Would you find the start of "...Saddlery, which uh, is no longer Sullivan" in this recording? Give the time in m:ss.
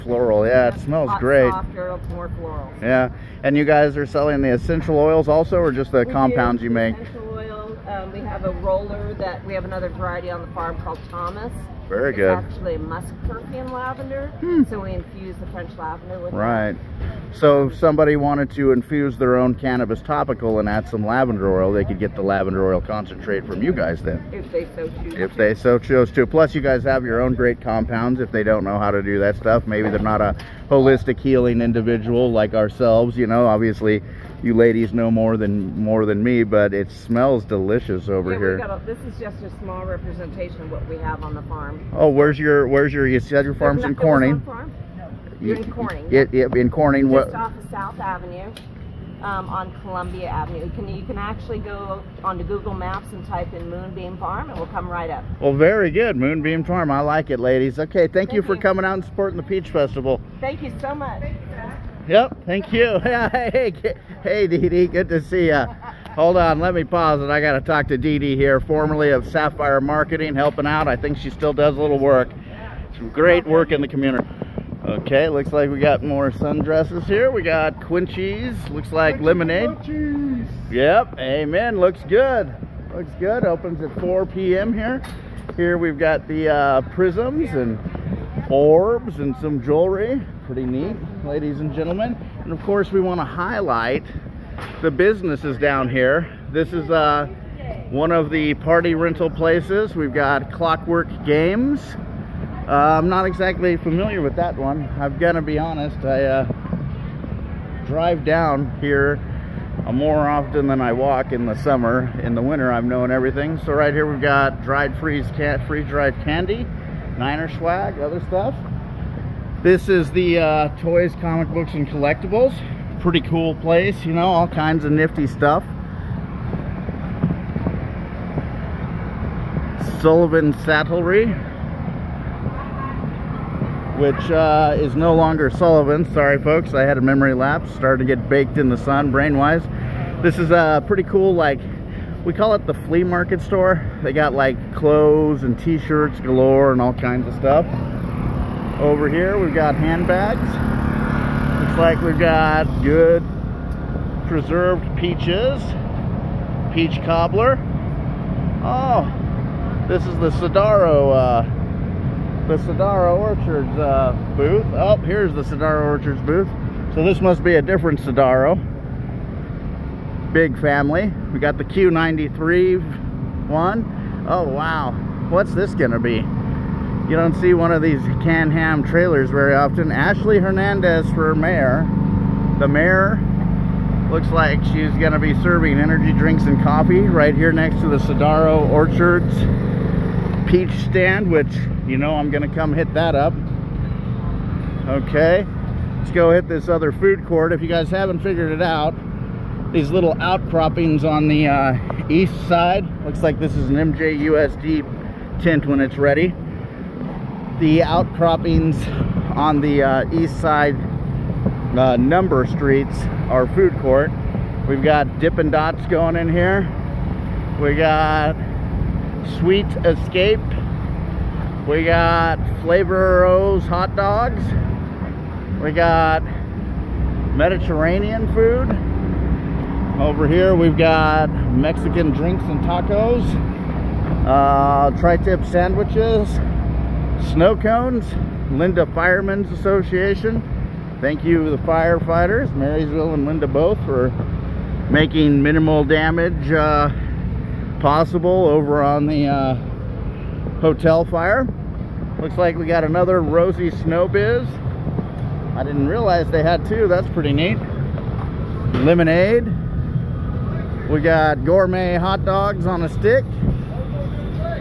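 2:10.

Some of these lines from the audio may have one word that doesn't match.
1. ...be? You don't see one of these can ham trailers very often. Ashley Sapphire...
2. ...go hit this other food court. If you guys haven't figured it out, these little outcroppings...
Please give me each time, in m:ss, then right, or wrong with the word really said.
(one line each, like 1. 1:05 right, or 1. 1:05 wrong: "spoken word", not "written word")
1. 2:55 wrong: "Hernandez", not "Sapphire"
2. 3:16 right.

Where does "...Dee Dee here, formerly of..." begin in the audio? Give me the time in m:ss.
1:07.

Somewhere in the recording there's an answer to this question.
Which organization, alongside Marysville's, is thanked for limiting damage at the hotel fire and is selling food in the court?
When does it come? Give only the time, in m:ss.
3:58.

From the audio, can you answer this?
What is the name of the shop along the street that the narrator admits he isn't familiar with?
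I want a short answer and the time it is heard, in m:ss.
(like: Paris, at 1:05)
Clockwork Games, at 1:40.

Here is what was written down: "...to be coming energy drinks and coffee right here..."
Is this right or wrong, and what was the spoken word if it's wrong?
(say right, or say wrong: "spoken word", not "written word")
wrong: "serving", not "coming".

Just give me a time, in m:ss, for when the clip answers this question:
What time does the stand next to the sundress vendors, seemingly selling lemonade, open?
1:24.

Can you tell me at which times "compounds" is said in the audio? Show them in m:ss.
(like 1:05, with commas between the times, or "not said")
0:06, 0:27.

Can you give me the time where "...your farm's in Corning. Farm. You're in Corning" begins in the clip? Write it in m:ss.
0:43.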